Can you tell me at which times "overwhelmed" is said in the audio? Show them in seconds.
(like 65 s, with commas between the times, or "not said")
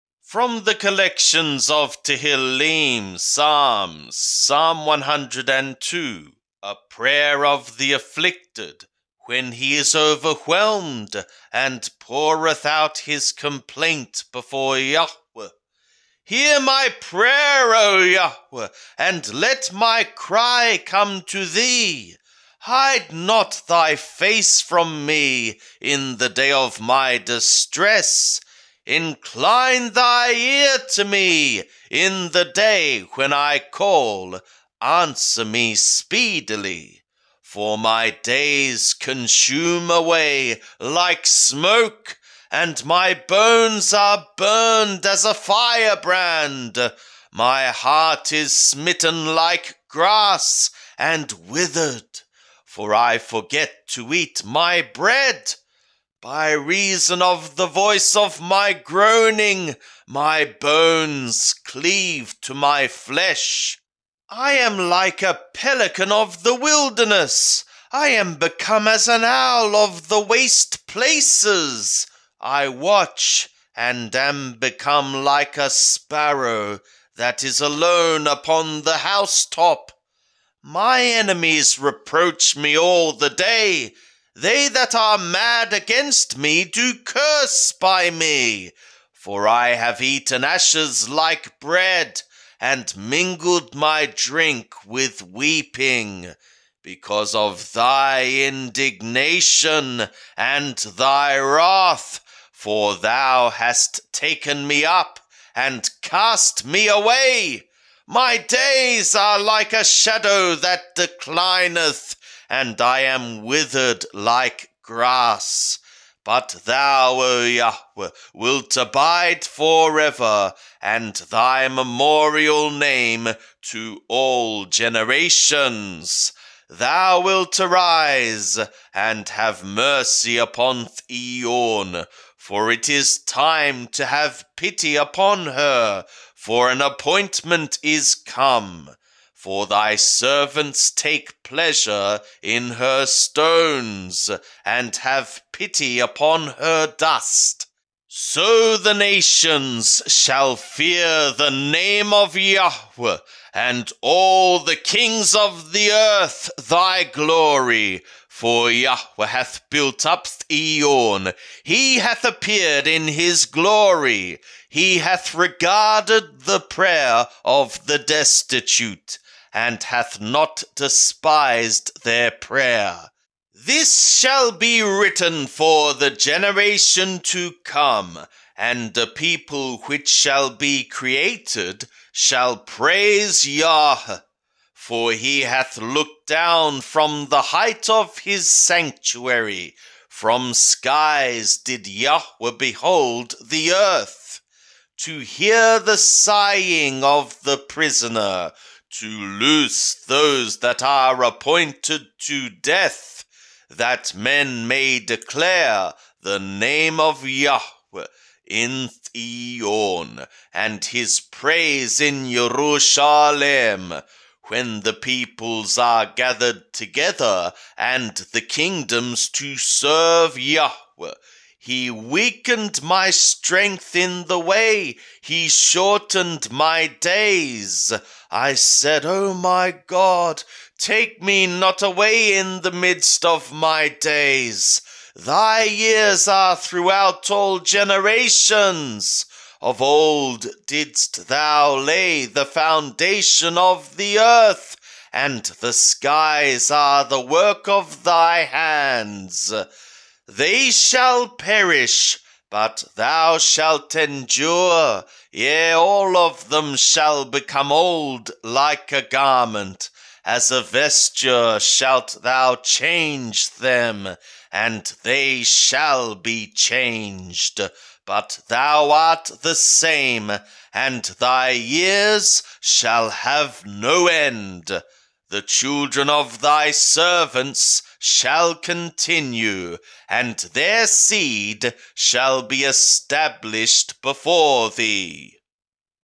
9 s.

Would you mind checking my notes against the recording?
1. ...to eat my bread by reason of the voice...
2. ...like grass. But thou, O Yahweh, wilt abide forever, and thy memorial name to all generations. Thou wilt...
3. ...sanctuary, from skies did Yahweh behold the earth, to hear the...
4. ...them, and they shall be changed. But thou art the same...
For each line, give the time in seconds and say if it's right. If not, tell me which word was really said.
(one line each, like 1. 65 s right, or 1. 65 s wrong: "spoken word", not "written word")
1. 53 s right
2. 114 s right
3. 188 s right
4. 263 s right.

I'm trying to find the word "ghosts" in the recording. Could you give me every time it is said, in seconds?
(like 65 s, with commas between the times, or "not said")
not said.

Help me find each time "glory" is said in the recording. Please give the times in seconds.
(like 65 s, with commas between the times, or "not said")
157 s, 163 s.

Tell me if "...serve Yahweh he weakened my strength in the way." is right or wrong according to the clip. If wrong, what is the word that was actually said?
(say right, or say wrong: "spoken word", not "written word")
right.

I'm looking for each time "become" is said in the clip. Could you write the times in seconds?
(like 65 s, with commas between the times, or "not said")
68 s, 74 s, 257 s.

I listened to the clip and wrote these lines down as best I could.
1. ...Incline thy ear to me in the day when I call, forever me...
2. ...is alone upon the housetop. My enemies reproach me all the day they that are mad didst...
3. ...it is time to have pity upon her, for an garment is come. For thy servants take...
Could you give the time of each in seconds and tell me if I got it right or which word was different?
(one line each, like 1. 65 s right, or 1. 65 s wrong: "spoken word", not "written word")
1. 28 s wrong: "answer", not "forever"
2. 77 s wrong: "against", not "didst"
3. 132 s wrong: "appointment", not "garment".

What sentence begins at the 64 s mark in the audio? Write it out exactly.
I am like a pelican of the wilderness.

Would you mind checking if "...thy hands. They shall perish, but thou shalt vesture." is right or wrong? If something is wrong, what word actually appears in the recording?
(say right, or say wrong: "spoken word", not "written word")
wrong: "endure", not "vesture".